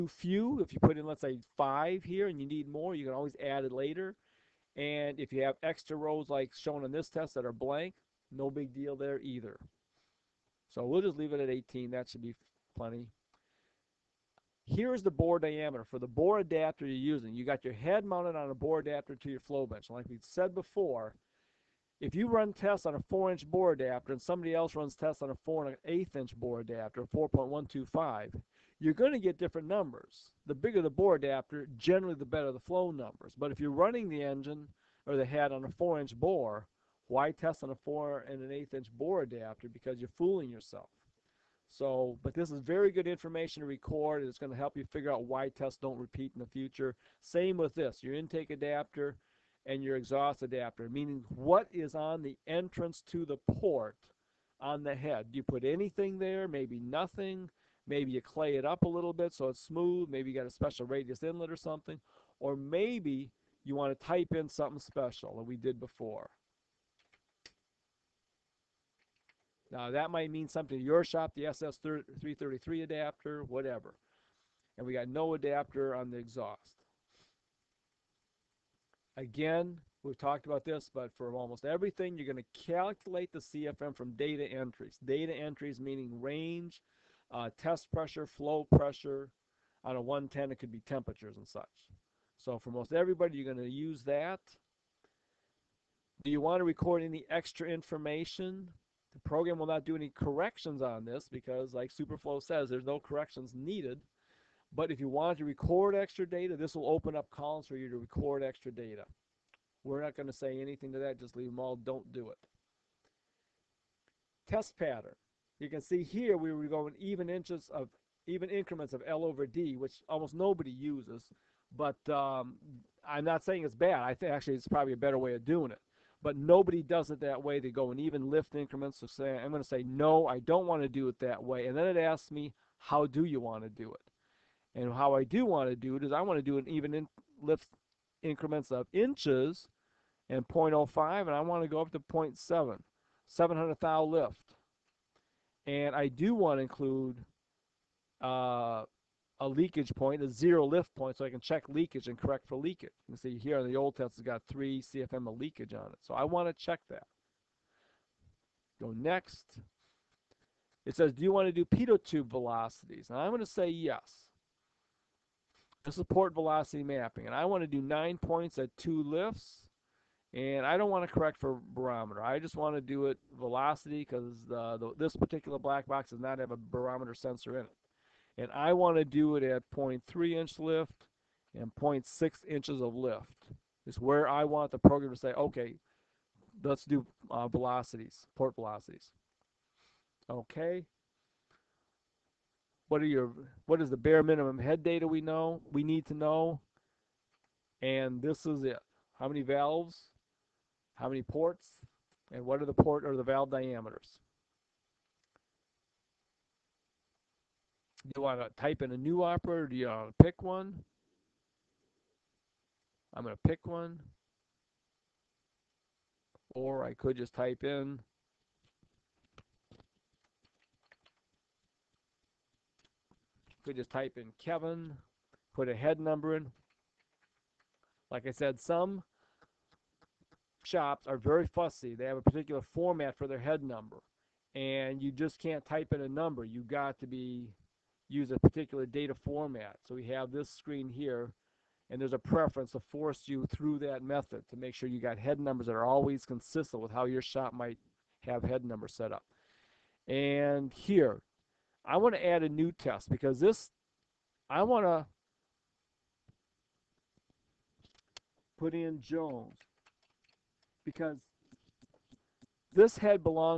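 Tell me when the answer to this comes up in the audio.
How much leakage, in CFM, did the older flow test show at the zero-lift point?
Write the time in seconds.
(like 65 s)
154 s.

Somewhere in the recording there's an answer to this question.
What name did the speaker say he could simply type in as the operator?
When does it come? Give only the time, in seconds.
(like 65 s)
224 s.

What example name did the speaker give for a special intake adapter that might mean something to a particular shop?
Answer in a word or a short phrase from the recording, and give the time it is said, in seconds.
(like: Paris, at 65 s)
SS333 adapter, at 71 s.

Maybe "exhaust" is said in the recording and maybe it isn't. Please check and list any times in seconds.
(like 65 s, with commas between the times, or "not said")
49 s, 76 s.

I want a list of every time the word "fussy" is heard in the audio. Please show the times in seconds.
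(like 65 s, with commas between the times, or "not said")
231 s.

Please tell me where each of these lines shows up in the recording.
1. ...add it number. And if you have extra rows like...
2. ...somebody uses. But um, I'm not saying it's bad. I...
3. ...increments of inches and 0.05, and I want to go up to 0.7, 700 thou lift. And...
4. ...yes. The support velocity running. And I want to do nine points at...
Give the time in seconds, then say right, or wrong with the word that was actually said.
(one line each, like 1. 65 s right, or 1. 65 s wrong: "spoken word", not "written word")
1. 3 s wrong: "later", not "number"
2. 120 s wrong: "nobody", not "somebody"
3. 138 s right
4. 163 s wrong: "mapping", not "running".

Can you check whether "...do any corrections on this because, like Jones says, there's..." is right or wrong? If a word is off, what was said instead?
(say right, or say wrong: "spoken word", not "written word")
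wrong: "Superflow", not "Jones".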